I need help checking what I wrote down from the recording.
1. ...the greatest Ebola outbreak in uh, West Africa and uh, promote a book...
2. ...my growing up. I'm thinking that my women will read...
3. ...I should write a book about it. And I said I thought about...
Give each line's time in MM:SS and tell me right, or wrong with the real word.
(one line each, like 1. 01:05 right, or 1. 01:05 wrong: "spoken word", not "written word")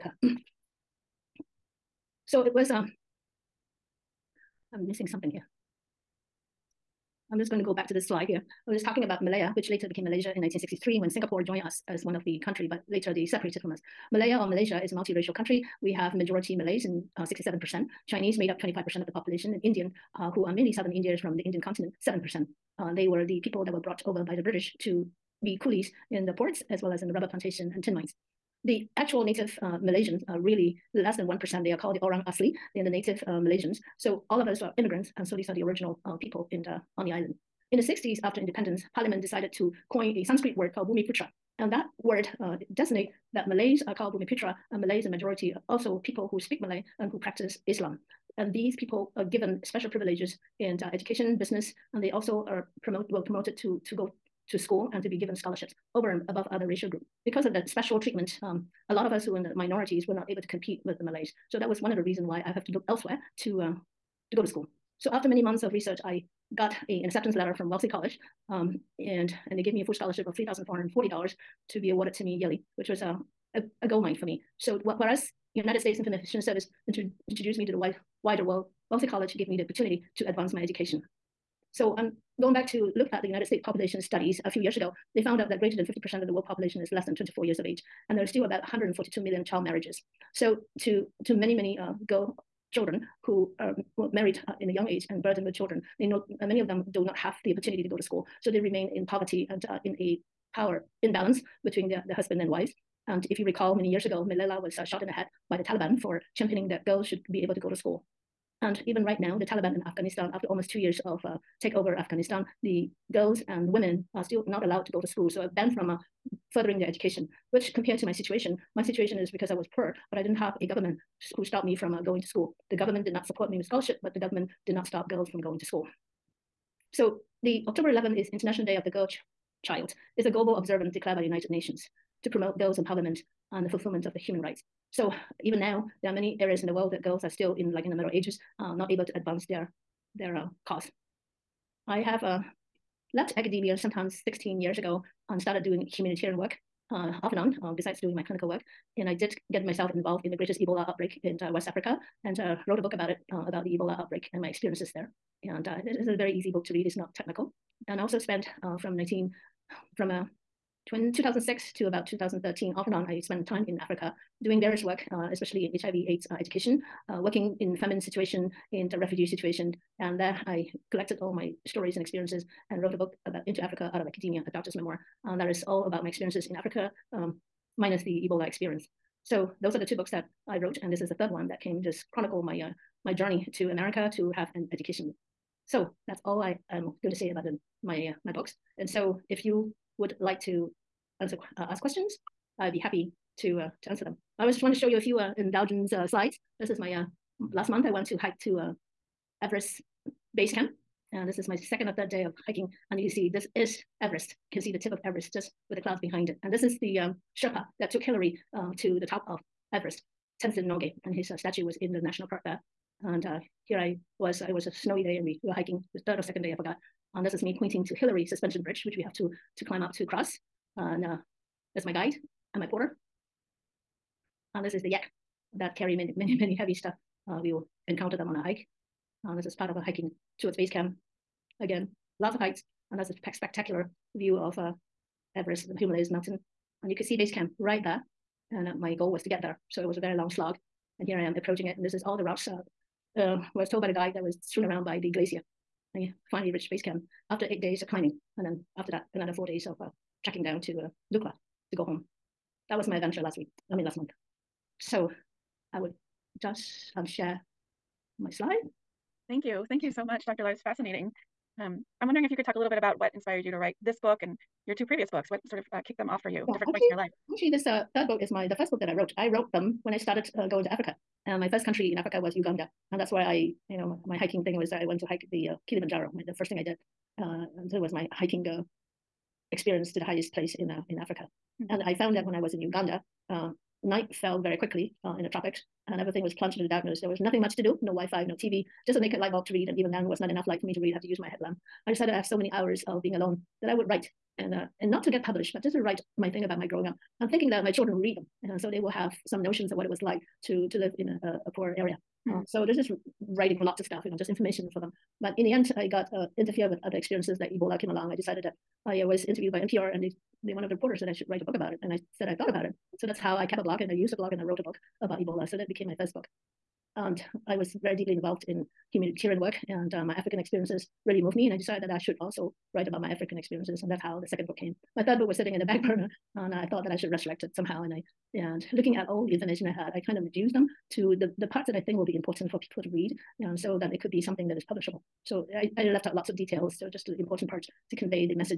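1. 02:30 wrong: "wrote", not "promote"
2. 04:56 wrong: "children", not "women"
3. 05:11 right.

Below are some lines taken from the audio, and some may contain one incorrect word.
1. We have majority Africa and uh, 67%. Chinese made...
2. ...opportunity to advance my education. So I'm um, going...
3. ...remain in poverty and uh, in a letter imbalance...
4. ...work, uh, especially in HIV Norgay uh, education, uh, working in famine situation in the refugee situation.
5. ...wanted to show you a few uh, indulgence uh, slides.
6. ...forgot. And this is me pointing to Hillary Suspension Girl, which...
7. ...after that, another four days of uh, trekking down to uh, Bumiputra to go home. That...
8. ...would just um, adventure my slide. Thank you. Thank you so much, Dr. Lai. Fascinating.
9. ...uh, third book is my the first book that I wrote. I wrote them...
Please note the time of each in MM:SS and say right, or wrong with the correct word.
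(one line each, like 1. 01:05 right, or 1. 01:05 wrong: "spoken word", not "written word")
1. 00:15 wrong: "Malays", not "Africa"
2. 01:19 right
3. 01:38 wrong: "power", not "letter"
4. 02:44 wrong: "AIDS", not "Norgay"
5. 03:14 right
6. 03:36 wrong: "Bridge", not "Girl"
7. 04:08 wrong: "Lukla", not "Bumiputra"
8. 04:15 wrong: "share", not "adventure"
9. 04:27 right.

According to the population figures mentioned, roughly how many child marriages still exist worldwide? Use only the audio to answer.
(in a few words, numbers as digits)
142 million.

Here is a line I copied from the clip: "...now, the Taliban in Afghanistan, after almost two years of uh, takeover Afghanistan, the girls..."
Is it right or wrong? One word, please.
right.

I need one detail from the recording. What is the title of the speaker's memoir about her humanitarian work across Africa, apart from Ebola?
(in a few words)
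Into Africa Out of Academia.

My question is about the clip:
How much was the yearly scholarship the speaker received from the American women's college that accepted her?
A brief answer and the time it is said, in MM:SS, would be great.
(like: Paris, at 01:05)
$3,440, at 01:10.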